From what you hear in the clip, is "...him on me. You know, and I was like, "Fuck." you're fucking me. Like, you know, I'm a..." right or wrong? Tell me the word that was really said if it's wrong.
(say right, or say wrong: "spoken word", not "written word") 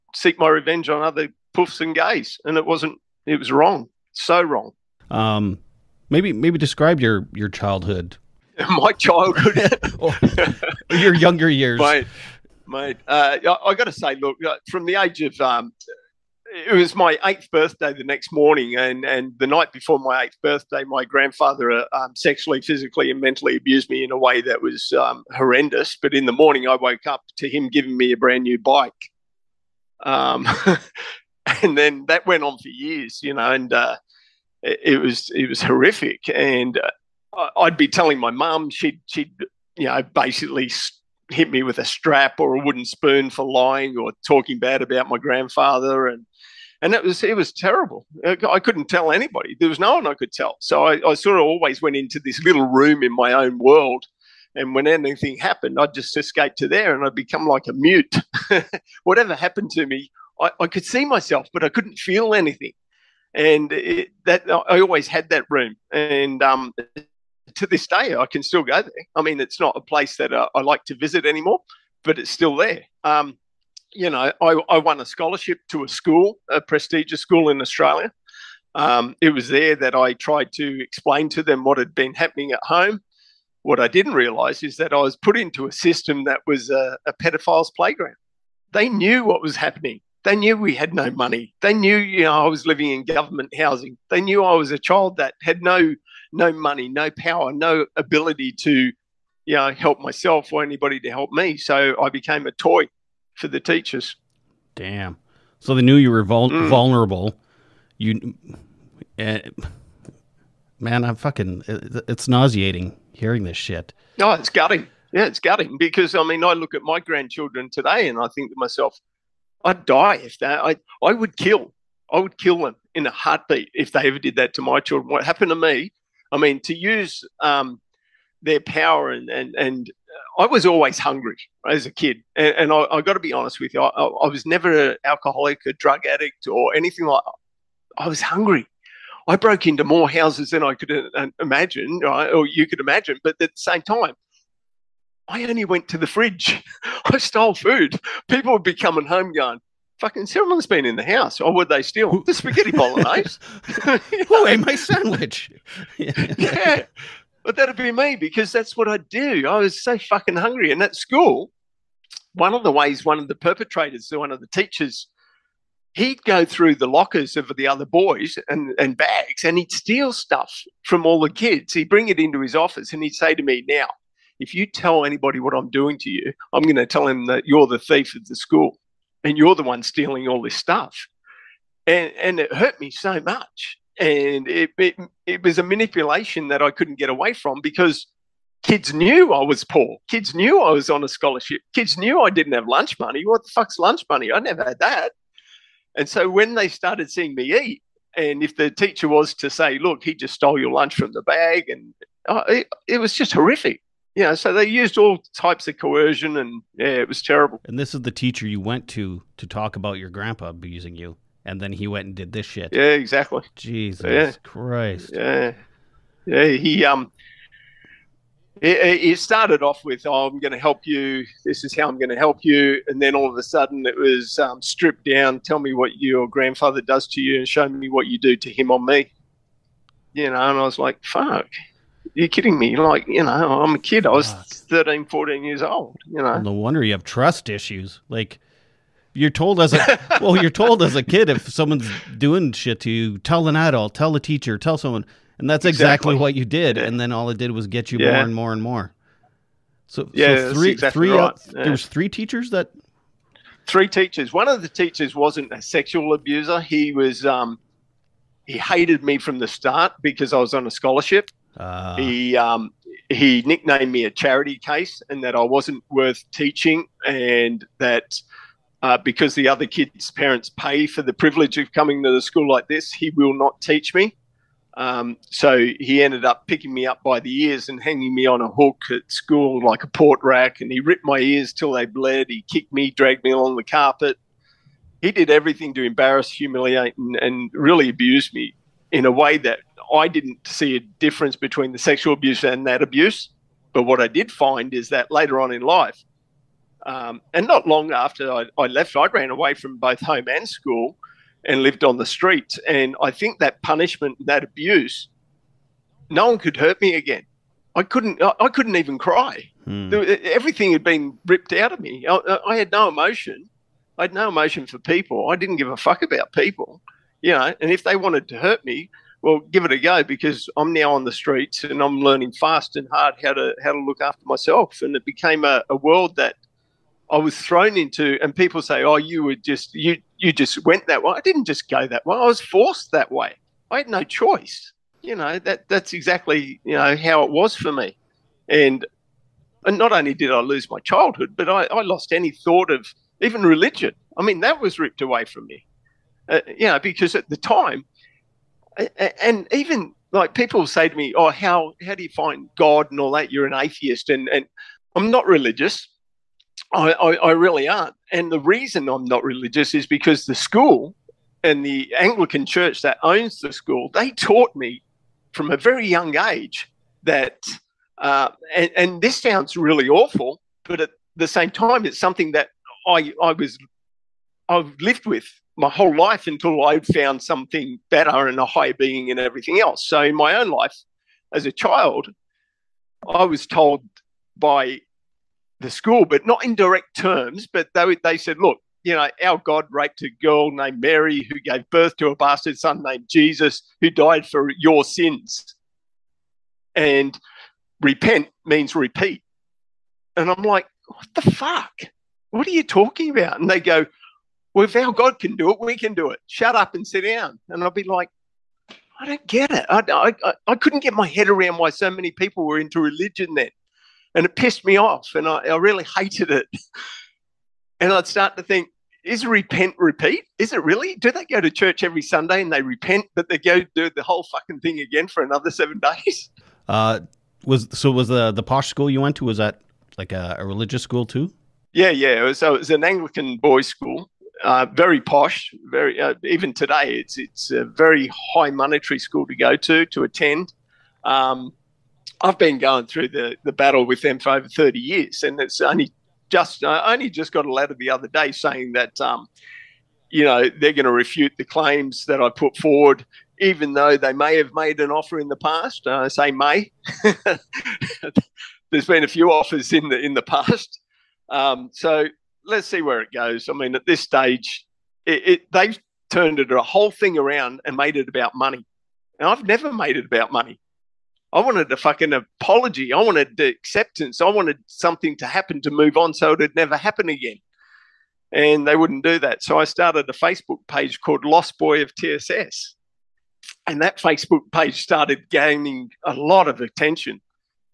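wrong: "kidding", not "fucking".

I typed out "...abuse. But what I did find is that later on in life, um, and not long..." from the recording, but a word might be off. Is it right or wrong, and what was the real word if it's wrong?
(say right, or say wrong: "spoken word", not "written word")
right.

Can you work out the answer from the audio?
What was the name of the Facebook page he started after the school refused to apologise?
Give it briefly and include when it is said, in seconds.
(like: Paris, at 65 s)
Lost Boy of TSS, at 481 s.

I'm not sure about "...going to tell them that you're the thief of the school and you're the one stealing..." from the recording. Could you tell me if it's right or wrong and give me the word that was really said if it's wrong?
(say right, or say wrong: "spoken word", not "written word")
right.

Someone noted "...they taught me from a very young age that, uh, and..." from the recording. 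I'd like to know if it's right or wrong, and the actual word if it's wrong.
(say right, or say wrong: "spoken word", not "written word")
right.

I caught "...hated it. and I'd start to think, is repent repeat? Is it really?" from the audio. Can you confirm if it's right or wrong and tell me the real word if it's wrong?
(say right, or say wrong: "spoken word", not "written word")
right.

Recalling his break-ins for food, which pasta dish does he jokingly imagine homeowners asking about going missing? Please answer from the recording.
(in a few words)
spaghetti bolognese.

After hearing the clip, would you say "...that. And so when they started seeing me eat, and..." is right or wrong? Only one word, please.
right.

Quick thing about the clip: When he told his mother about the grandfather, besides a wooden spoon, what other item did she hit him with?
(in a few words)
strap.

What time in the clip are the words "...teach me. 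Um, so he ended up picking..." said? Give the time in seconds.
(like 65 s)
273 s.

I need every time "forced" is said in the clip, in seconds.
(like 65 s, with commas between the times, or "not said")
332 s.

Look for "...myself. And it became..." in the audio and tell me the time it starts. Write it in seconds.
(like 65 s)
324 s.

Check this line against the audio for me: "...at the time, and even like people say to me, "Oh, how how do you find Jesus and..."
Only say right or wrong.
wrong.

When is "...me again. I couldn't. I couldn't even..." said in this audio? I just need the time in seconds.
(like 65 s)
306 s.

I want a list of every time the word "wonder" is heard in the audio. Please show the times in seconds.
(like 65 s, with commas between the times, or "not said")
236 s.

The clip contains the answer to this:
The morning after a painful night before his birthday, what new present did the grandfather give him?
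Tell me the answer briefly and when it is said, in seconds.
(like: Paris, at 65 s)
bike, at 28 s.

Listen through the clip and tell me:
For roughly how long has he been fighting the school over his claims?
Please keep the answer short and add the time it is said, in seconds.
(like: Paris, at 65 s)
over 30 years, at 444 s.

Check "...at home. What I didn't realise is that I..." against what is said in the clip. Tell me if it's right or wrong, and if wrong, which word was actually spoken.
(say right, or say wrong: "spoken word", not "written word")
right.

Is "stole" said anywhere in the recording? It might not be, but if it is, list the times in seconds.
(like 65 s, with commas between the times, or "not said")
147 s, 200 s.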